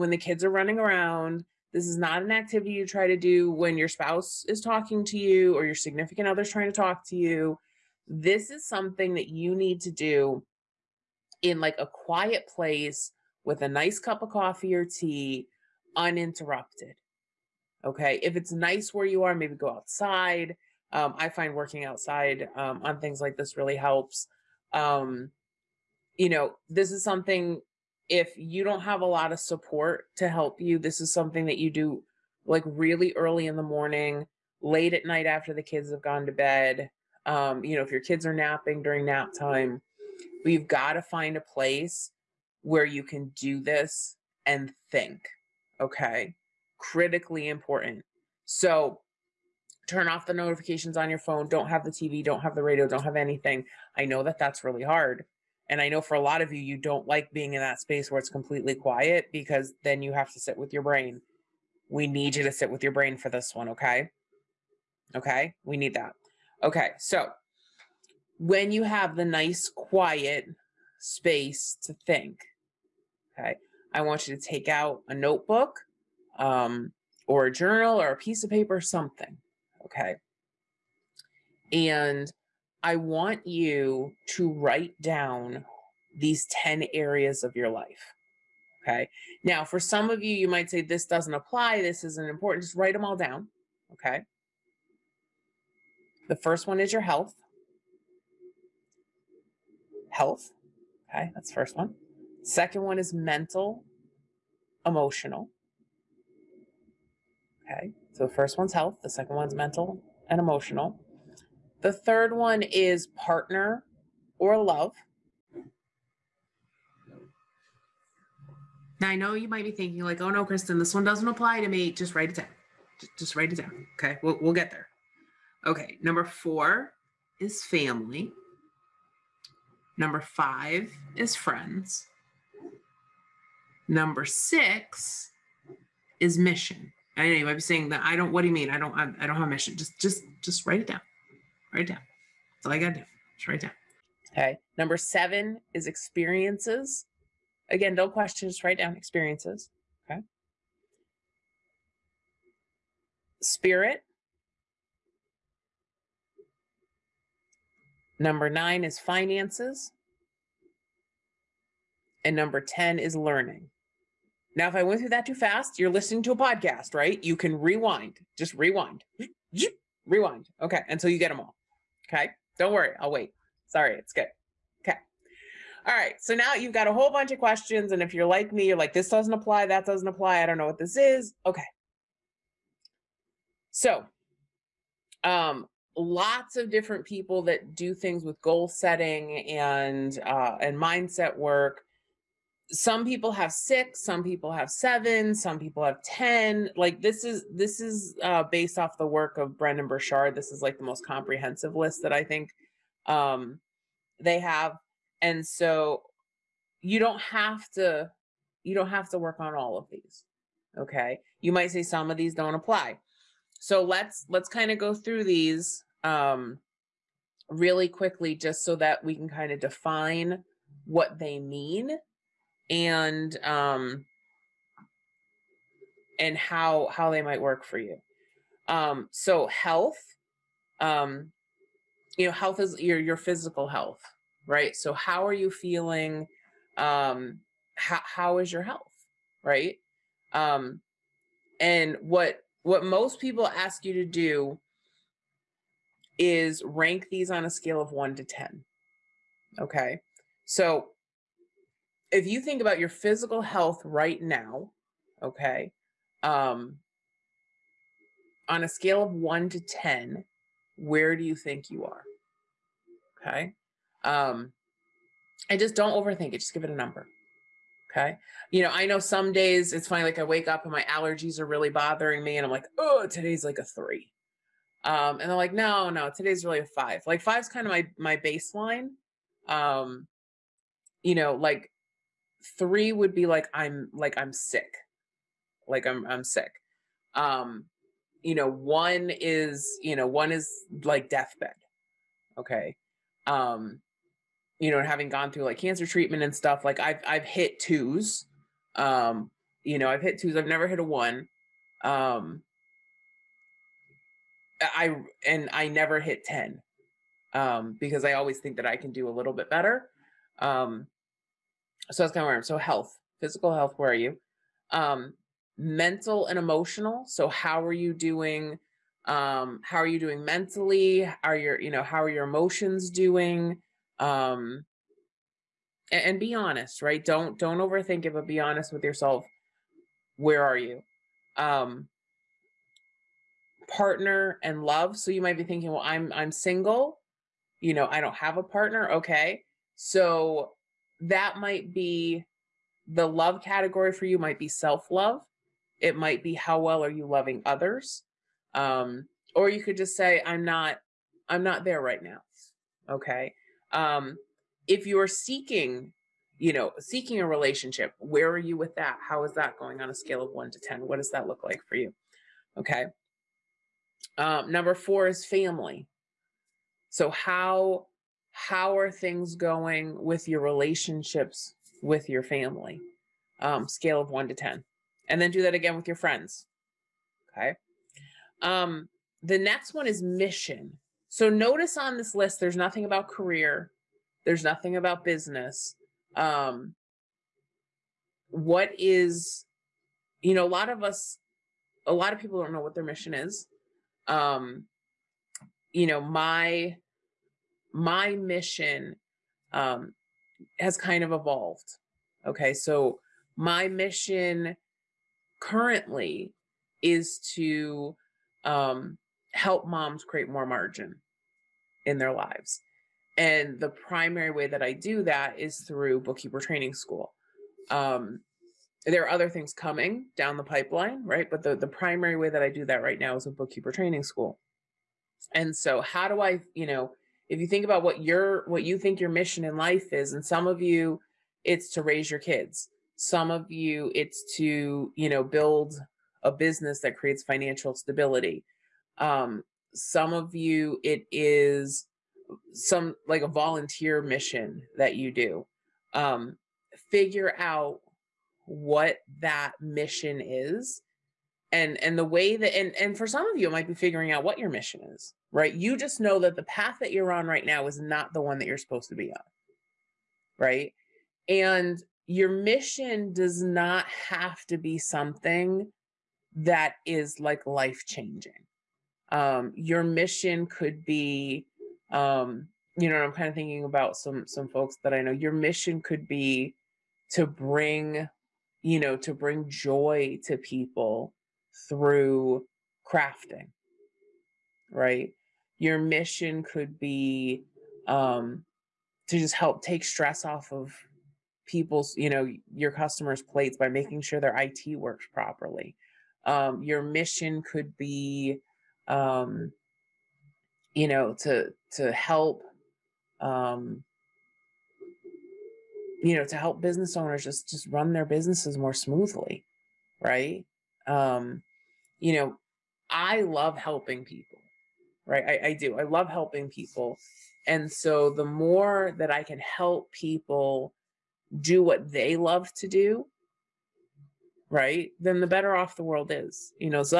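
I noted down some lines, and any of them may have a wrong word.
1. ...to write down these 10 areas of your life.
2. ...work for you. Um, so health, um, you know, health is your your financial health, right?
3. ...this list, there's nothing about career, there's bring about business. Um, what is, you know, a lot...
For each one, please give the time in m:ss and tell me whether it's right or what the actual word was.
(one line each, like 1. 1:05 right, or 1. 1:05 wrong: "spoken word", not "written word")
1. 1:24 right
2. 3:47 wrong: "physical", not "financial"
3. 6:21 wrong: "nothing", not "bring".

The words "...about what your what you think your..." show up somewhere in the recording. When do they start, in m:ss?
7:07.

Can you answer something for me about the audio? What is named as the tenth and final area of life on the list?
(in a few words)
learning.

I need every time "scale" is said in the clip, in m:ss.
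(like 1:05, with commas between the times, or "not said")
4:07, 4:18, 5:59, 6:13.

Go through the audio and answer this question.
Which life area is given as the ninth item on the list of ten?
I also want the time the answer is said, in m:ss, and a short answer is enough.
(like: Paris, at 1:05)
finances, at 2:38.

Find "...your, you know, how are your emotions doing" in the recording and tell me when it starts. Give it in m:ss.
5:21.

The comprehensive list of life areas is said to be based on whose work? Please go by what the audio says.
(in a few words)
Brendon Burchard.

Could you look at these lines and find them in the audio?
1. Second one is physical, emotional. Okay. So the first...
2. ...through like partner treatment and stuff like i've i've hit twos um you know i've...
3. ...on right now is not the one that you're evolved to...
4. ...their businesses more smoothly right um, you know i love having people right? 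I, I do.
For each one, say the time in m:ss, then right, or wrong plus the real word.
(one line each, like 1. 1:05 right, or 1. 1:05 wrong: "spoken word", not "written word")
1. 1:42 wrong: "mental", not "physical"
2. 4:55 wrong: "cancer", not "partner"
3. 7:37 wrong: "supposed", not "evolved"
4. 8:27 wrong: "helping", not "having".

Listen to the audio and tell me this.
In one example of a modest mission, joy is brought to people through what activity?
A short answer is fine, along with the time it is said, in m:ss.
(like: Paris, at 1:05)
crafting, at 8:02.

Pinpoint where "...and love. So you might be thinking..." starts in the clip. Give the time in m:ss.
5:34.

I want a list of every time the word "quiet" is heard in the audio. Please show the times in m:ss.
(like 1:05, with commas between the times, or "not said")
0:11, 0:58, 1:09.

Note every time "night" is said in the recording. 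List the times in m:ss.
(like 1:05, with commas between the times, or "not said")
0:35.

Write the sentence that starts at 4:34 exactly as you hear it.
Um, and they're like, no, no, today's really a five.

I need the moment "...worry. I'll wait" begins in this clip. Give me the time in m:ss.
2:52.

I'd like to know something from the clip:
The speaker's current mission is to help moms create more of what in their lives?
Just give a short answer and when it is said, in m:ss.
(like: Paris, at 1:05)
margin, at 6:50.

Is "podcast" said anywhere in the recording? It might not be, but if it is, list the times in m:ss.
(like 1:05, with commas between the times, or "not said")
2:46.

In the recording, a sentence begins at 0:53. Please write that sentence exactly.
I know that that's really hard.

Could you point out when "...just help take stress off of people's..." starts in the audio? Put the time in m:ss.
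8:09.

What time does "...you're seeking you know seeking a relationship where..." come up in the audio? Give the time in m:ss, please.
5:54.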